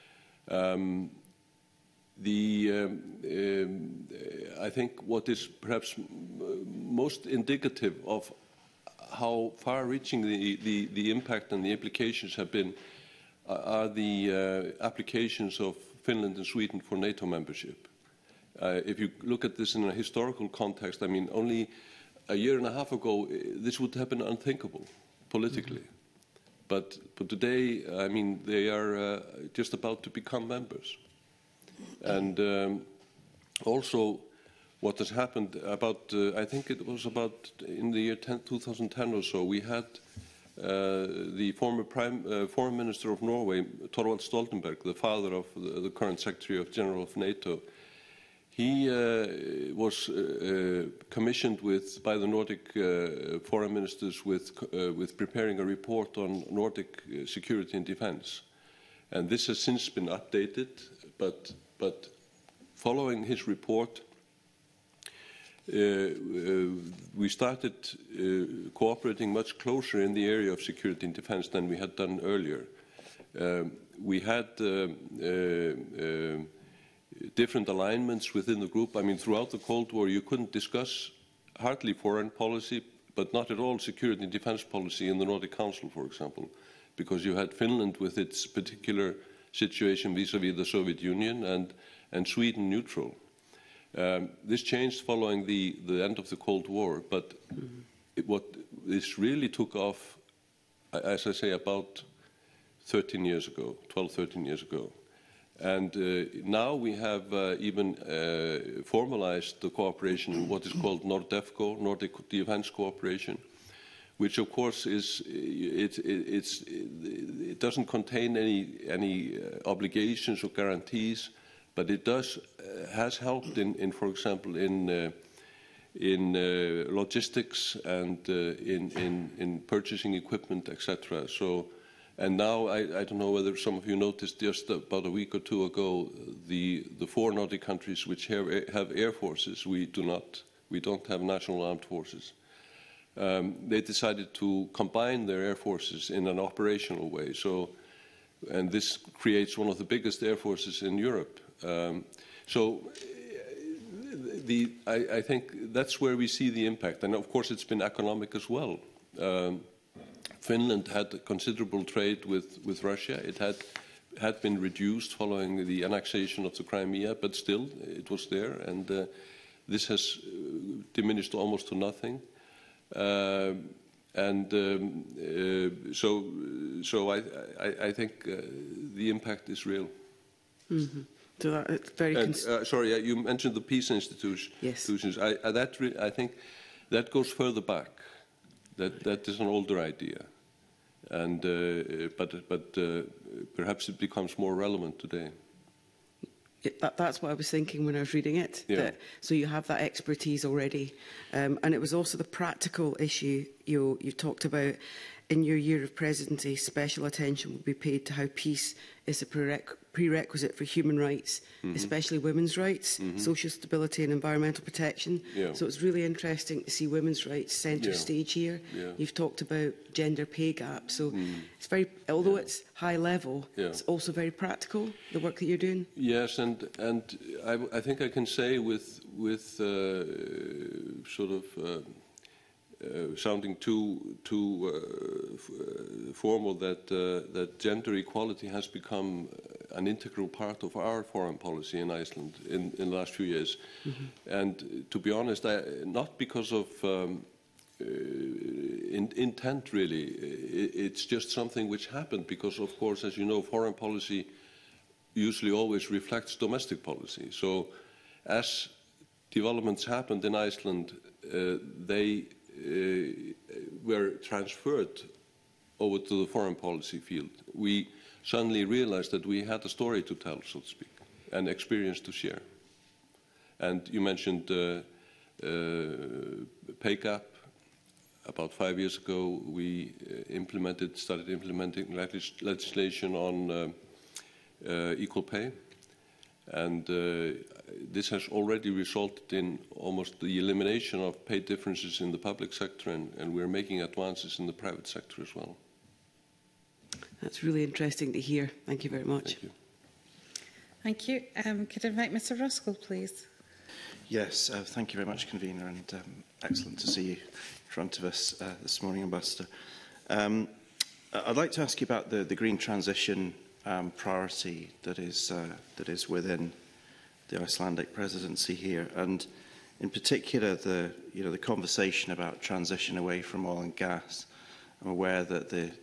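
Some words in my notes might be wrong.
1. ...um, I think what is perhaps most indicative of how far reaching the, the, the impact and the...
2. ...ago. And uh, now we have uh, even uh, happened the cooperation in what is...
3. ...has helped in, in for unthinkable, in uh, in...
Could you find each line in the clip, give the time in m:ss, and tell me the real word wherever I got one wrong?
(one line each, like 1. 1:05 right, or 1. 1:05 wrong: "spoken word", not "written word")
1. 0:03 right
2. 1:44 wrong: "formalized", not "happened"
3. 2:02 wrong: "example", not "unthinkable".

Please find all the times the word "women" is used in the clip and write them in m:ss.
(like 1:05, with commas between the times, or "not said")
3:32, 3:36.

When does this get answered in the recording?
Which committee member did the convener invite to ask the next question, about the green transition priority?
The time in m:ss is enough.
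5:02.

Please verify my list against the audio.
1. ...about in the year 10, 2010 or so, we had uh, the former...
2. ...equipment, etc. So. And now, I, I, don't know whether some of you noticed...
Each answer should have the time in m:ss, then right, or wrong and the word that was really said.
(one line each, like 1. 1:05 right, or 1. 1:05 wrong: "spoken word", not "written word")
1. 0:37 right
2. 2:10 right.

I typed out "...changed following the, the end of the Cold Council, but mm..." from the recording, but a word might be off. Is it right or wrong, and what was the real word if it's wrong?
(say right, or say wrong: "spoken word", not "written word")
wrong: "War", not "Council".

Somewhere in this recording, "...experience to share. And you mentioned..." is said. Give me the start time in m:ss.
4:31.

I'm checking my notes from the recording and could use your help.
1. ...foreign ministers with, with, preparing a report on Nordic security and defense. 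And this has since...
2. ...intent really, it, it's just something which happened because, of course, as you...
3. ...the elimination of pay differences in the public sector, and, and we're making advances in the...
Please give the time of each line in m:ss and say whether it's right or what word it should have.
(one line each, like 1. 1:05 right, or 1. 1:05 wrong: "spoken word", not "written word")
1. 0:53 right
2. 4:09 right
3. 4:50 right.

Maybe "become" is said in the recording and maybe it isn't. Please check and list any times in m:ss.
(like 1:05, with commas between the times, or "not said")
0:30, 3:13, 3:58.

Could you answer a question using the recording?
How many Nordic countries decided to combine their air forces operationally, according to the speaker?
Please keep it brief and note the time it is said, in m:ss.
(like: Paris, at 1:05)
4, at 2:17.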